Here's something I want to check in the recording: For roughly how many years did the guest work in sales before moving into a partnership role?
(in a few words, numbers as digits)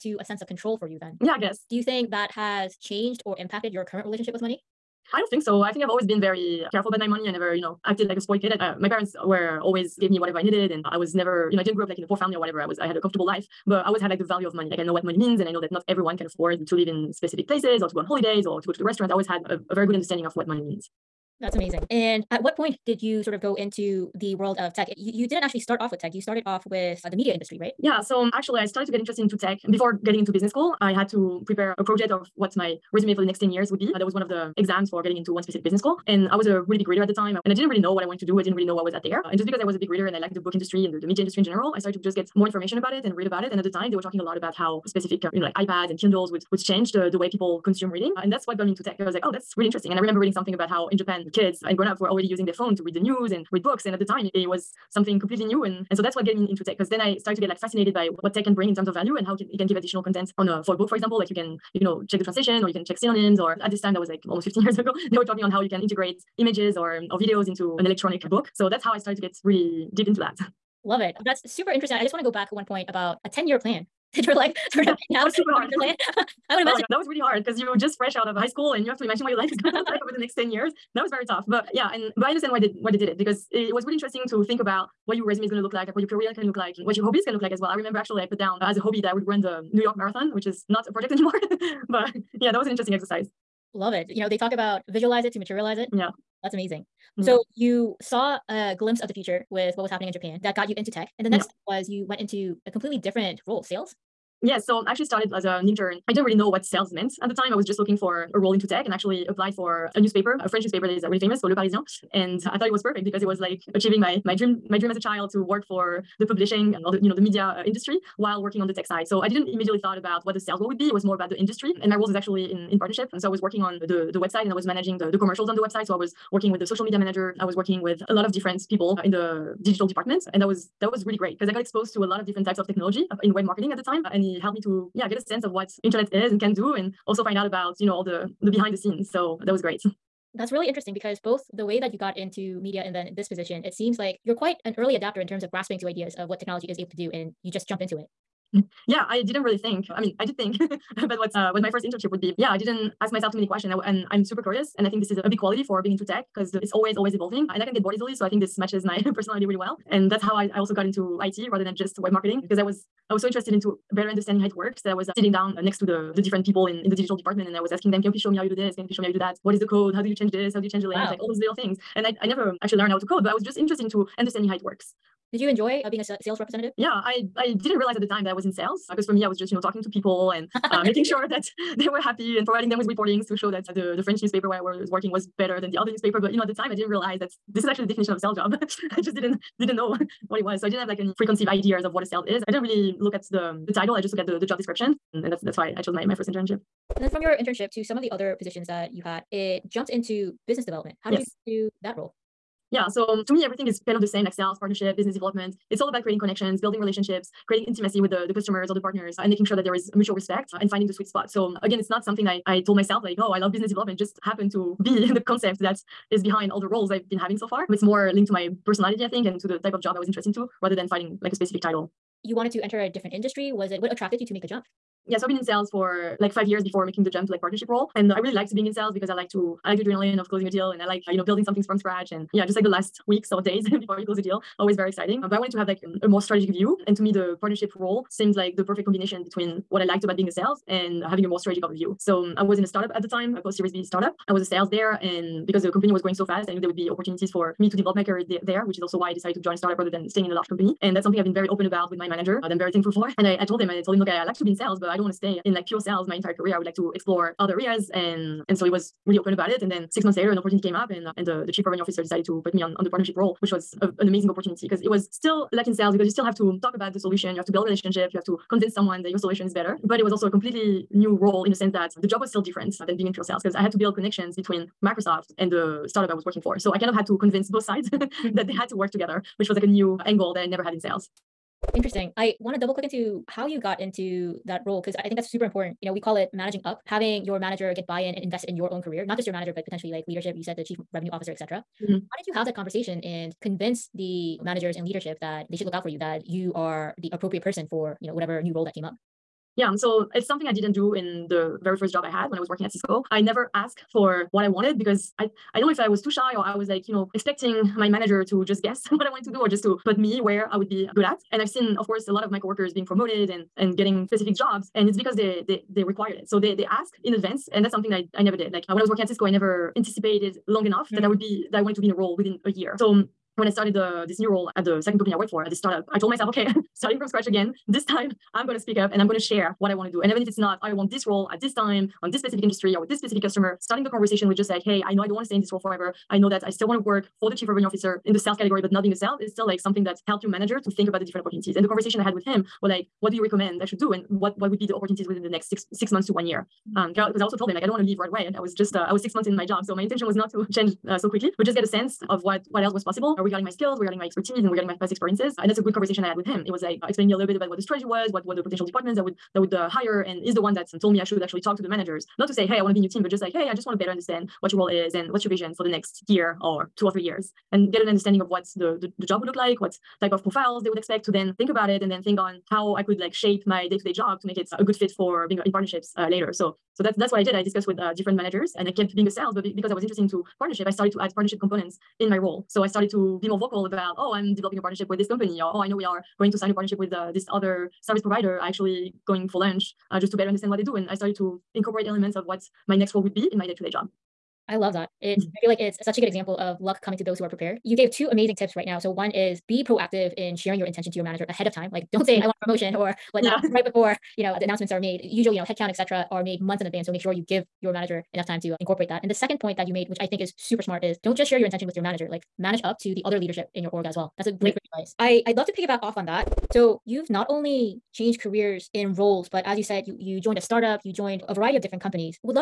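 5.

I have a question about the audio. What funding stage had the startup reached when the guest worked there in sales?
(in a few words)
Post Series B.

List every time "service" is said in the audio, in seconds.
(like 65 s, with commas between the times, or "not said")
387 s.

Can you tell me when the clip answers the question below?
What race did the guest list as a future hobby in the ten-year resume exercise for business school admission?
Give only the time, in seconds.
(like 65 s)
89 s.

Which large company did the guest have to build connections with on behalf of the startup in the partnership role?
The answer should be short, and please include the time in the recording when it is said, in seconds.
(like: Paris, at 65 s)
Microsoft, at 274 s.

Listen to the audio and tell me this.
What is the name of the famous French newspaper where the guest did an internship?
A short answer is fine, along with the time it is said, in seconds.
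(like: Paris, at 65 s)
Le Parisien, at 111 s.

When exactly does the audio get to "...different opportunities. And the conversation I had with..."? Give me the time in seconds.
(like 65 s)
341 s.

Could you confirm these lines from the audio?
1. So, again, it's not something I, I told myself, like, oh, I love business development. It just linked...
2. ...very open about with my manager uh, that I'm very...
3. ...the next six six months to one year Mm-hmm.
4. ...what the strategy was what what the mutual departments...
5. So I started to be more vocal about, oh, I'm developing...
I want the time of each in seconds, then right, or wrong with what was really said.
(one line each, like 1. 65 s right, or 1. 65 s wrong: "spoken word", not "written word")
1. 211 s wrong: "happened", not "linked"
2. 251 s right
3. 345 s right
4. 357 s wrong: "potential", not "mutual"
5. 382 s right.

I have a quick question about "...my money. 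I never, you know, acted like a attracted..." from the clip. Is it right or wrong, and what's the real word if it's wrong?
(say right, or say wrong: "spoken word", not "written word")
wrong: "spoiled", not "attracted".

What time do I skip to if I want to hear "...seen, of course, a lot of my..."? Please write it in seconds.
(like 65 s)
311 s.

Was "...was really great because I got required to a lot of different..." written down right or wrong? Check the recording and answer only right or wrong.
wrong.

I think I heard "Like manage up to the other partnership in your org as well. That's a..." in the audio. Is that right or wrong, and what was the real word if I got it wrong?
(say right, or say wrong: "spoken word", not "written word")
wrong: "leadership", not "partnership".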